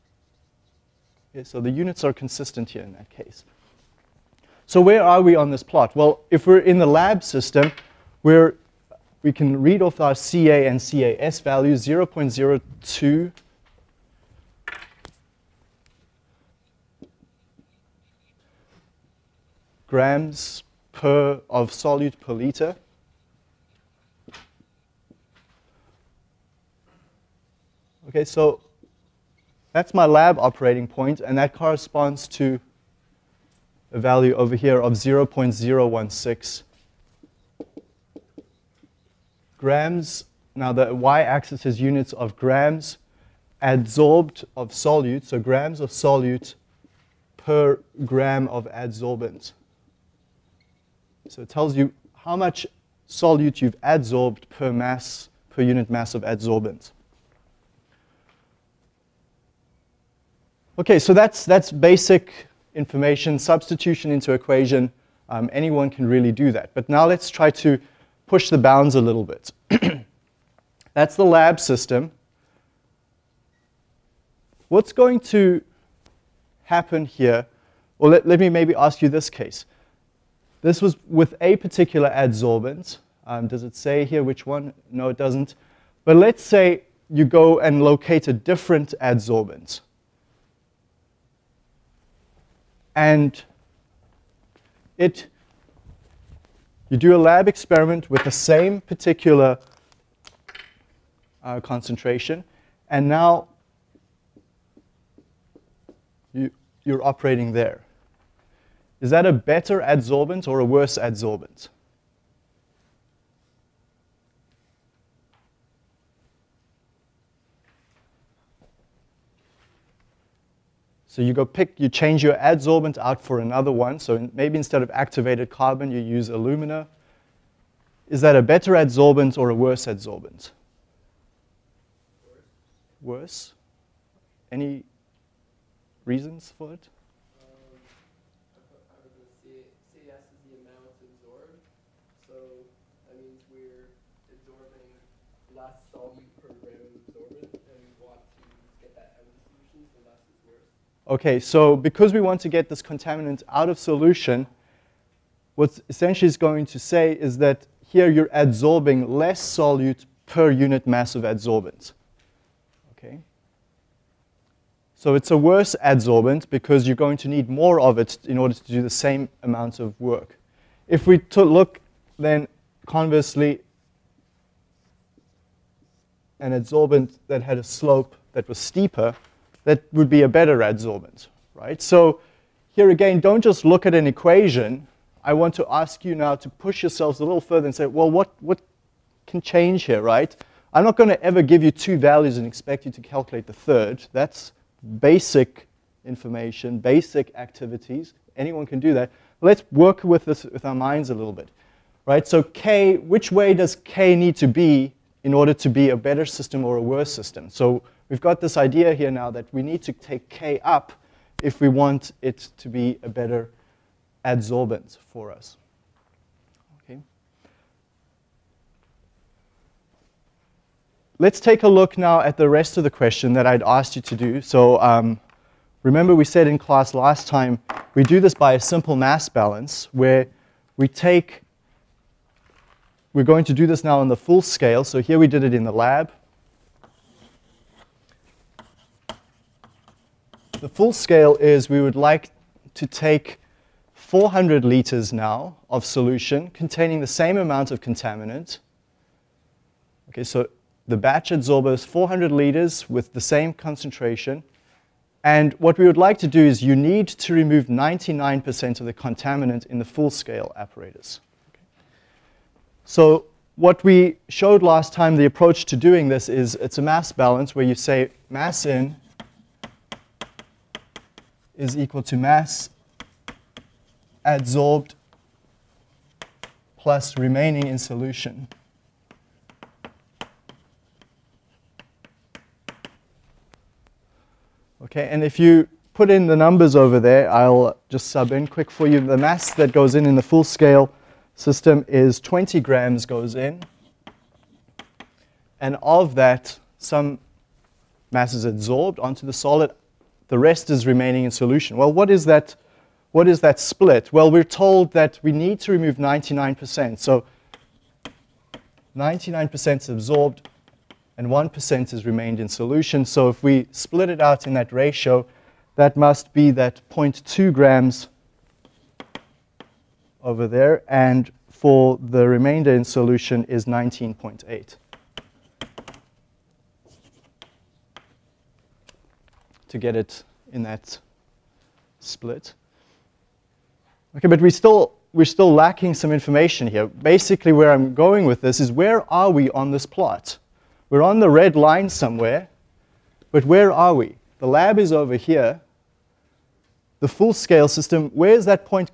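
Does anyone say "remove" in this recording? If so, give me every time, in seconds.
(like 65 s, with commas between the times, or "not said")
257 s, 305 s.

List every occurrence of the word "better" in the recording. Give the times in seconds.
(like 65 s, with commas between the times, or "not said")
109 s, 128 s, 180 s, 205 s, 213 s.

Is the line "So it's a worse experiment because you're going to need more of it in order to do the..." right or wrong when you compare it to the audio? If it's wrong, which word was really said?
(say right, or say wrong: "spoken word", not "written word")
wrong: "adsorbent", not "experiment".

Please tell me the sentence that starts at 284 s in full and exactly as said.
Okay, and if you put in the numbers over there, I'll just sub in quick for you.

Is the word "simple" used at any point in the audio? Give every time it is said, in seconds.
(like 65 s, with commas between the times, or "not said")
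228 s.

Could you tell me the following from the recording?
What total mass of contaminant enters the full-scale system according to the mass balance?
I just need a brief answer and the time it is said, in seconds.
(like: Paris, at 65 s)
20 grams, at 292 s.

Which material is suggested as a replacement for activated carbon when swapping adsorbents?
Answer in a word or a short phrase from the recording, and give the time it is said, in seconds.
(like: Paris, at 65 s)
alumina, at 126 s.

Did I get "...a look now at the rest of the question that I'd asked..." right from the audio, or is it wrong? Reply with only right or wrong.
right.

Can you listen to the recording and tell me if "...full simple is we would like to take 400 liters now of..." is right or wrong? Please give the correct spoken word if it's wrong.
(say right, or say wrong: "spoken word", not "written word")
wrong: "scale", not "simple".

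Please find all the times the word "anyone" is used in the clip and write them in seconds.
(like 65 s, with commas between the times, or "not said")
65 s, 198 s.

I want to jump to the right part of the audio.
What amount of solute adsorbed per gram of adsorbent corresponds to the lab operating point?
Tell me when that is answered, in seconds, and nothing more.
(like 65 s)
34 s.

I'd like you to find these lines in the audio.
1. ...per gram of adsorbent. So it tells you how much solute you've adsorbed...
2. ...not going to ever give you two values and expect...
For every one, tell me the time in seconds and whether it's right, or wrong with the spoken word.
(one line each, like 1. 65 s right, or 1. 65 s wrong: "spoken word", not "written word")
1. 47 s right
2. 190 s right.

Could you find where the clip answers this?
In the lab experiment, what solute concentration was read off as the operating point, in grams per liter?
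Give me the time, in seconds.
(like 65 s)
11 s.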